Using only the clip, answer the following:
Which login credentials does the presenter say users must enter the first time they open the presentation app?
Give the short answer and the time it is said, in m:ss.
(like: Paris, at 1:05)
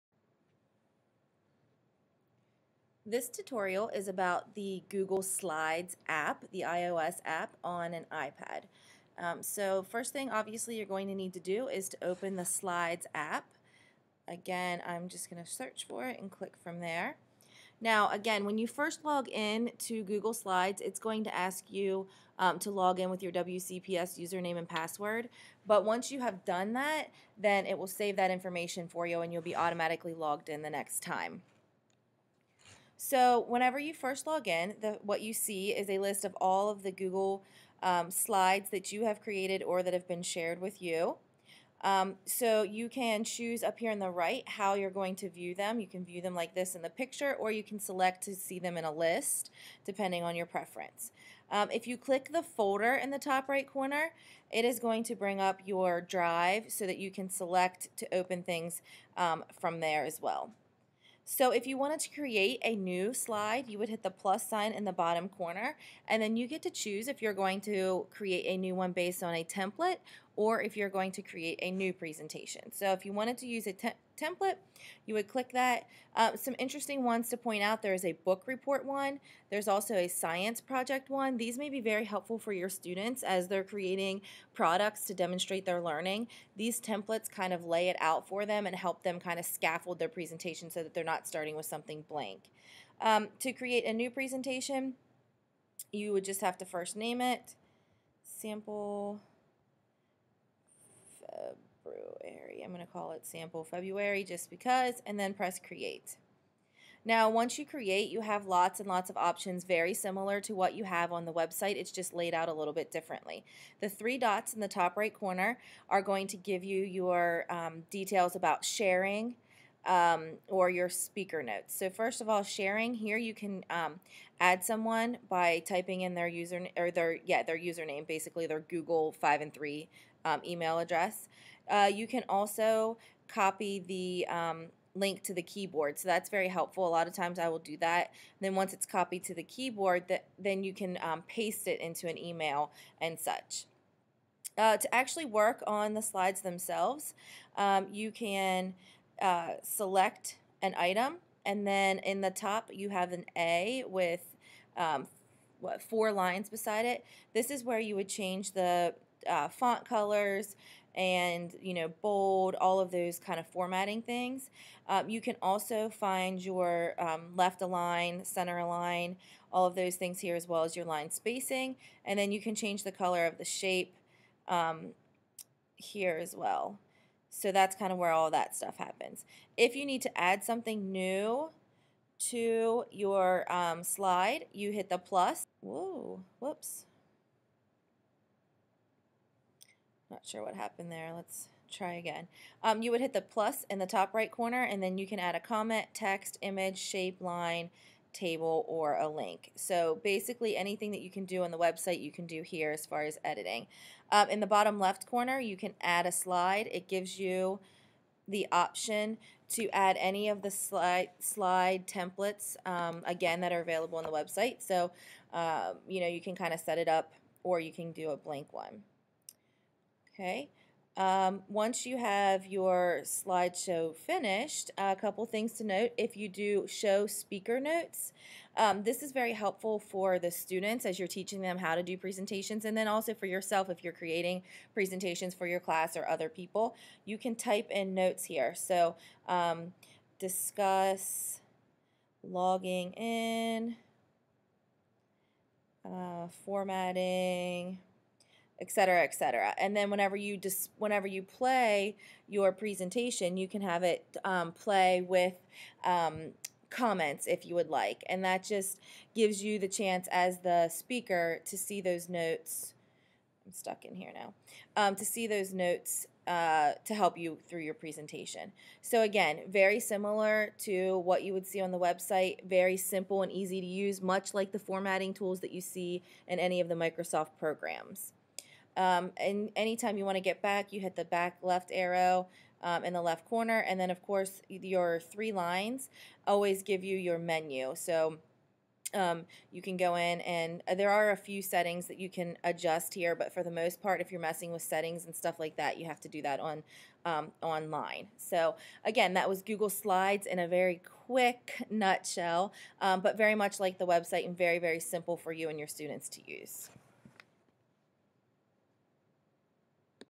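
WCPS username and password, at 0:23.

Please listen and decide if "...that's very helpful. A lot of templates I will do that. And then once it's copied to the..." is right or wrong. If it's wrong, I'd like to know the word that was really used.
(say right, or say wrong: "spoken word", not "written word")
wrong: "times", not "templates".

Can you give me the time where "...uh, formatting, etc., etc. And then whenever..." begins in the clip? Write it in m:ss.
4:05.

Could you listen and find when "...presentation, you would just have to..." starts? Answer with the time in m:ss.
1:34.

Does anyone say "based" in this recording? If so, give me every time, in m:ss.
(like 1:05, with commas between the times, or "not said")
1:08.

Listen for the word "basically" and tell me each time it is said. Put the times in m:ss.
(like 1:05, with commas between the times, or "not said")
2:08, 3:20.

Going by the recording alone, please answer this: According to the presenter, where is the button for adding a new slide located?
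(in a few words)
bottom left corner.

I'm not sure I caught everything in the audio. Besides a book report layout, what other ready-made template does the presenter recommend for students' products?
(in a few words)
science project.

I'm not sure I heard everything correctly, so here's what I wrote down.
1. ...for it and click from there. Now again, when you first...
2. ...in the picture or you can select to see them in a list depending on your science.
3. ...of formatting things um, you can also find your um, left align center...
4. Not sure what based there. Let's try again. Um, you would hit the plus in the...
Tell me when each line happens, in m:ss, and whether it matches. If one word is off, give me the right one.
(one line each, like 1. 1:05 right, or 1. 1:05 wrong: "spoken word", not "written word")
1. 0:15 right
2. 0:46 wrong: "preference", not "science"
3. 2:43 right
4. 3:10 wrong: "happened", not "based".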